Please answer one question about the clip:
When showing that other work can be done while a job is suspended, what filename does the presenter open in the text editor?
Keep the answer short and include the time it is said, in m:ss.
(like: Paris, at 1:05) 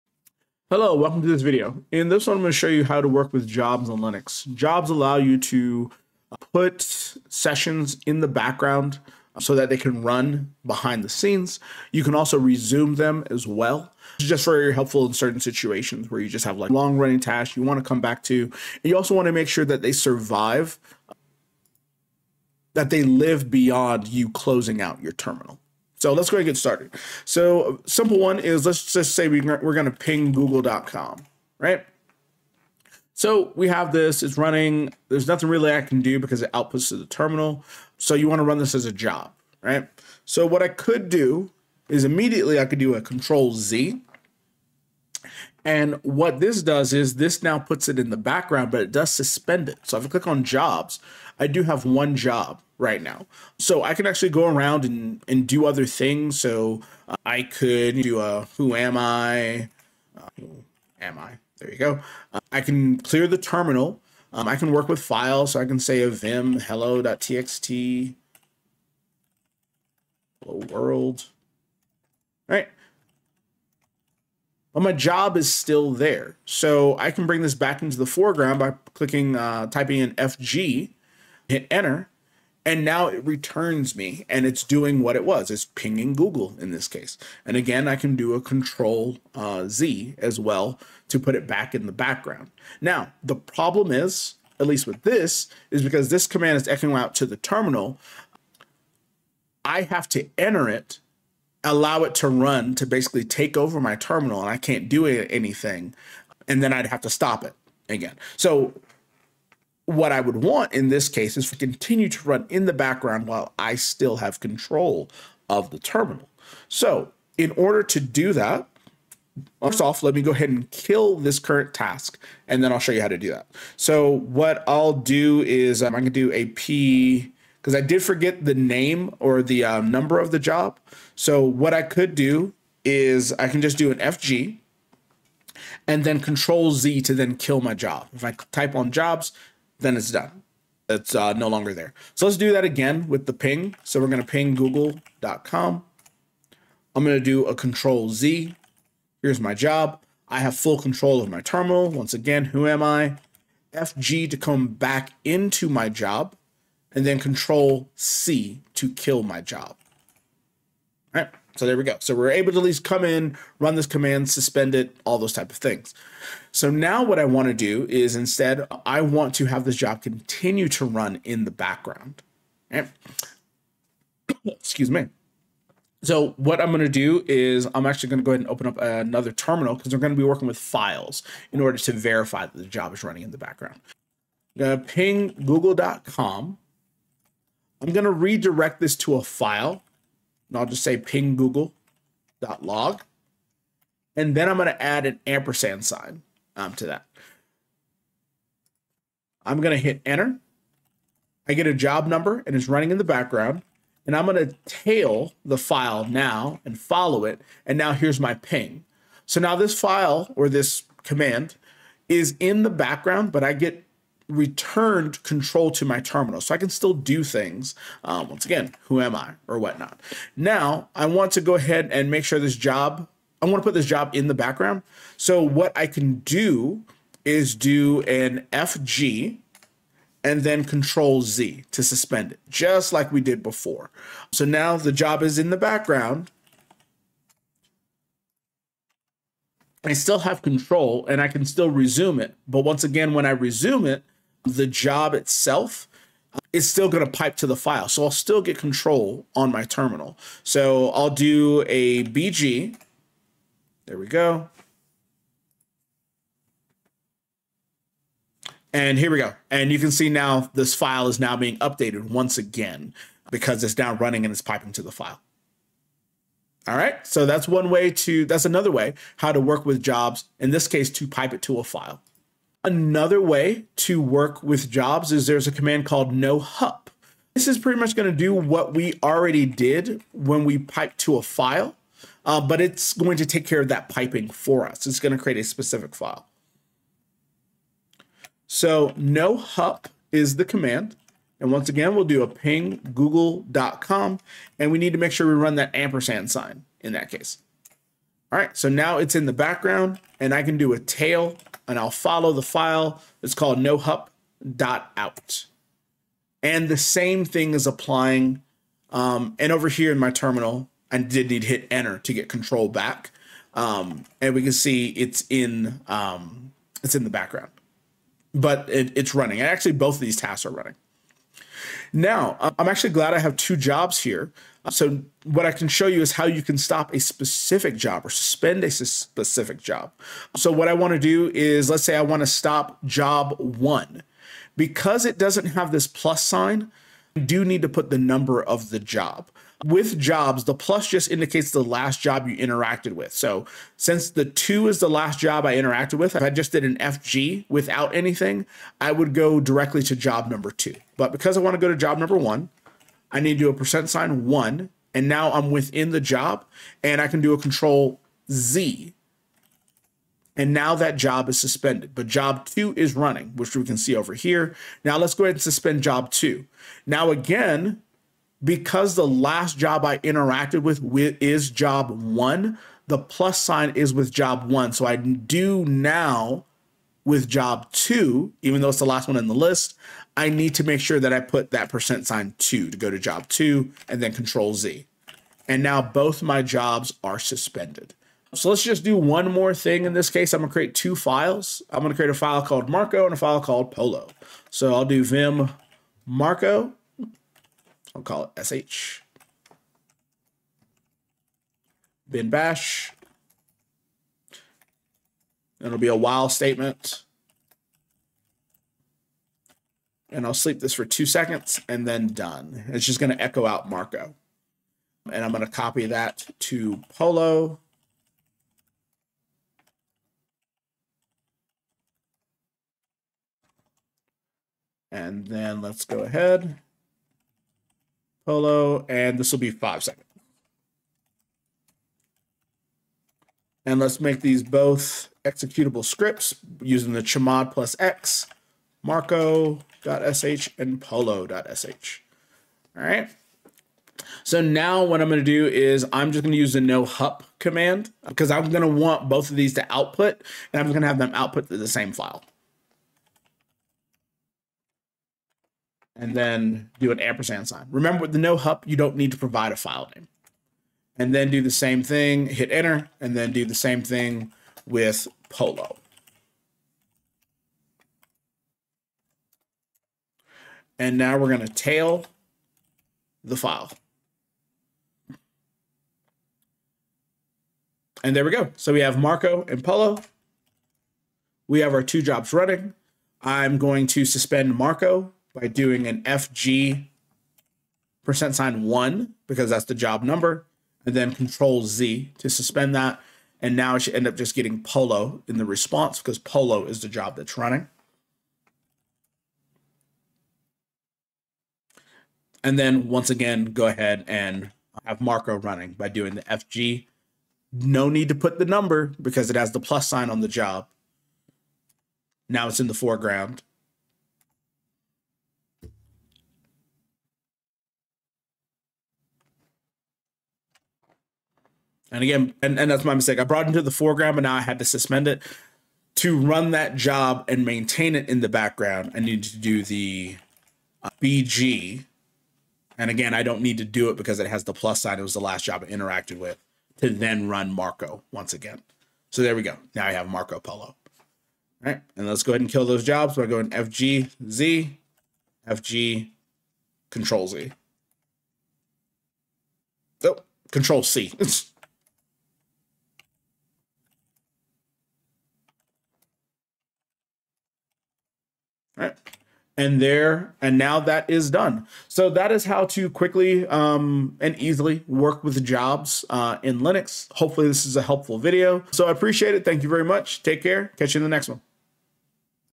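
hello.txt, at 1:06.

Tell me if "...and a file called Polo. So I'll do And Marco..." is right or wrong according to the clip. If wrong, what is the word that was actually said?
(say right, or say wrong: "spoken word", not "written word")
wrong: "Vim", not "And".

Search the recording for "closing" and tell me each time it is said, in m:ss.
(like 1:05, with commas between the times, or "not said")
0:24.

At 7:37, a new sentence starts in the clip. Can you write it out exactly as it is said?
Remember with the no hup, you don't need to provide a file name.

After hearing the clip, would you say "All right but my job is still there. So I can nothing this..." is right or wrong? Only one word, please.
wrong.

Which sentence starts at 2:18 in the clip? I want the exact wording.
If I type on jobs, then it's done.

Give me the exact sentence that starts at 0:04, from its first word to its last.
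Jobs allow you to put sessions in the background so that they can run behind the scenes.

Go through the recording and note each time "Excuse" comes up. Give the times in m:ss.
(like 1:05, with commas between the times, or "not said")
2:54.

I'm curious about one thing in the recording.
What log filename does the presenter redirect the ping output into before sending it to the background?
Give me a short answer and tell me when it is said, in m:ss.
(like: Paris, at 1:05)
ping google.log, at 3:10.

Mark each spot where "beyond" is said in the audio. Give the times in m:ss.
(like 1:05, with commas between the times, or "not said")
0:23.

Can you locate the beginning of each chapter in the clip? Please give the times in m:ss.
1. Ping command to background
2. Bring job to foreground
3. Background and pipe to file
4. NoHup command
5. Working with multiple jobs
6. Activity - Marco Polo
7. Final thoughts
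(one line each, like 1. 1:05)
1. 0:26
2. 1:16
3. 2:55
4. 4:32
5. 5:21
6. 6:28
7. 9:21.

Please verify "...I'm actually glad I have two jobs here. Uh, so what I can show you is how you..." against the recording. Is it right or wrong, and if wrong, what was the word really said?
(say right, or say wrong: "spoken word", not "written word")
right.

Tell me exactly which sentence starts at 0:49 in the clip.
So if I click on jobs, I do have one job right now.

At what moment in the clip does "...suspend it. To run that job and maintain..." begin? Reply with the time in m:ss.
8:44.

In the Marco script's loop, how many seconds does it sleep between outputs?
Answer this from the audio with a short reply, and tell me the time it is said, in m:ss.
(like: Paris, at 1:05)
2, at 6:50.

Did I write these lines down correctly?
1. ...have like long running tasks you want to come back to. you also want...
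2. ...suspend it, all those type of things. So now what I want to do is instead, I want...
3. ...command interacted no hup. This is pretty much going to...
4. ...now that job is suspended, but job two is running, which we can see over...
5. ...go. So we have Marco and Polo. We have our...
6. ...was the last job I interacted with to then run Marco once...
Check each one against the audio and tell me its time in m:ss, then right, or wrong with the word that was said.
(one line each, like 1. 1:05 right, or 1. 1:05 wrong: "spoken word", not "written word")
1. 0:16 right
2. 2:44 right
3. 4:35 wrong: "called", not "interacted"
4. 6:00 right
5. 7:58 right
6. 8:55 right.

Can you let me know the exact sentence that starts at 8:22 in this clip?
And then once again, go ahead and have Marco running by doing the FG.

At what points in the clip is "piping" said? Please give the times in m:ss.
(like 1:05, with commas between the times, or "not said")
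4:24, 4:43.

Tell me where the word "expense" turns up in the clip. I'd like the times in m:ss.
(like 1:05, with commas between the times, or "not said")
not said.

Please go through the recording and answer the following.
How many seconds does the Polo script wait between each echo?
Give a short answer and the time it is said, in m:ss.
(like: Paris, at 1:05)
5, at 7:09.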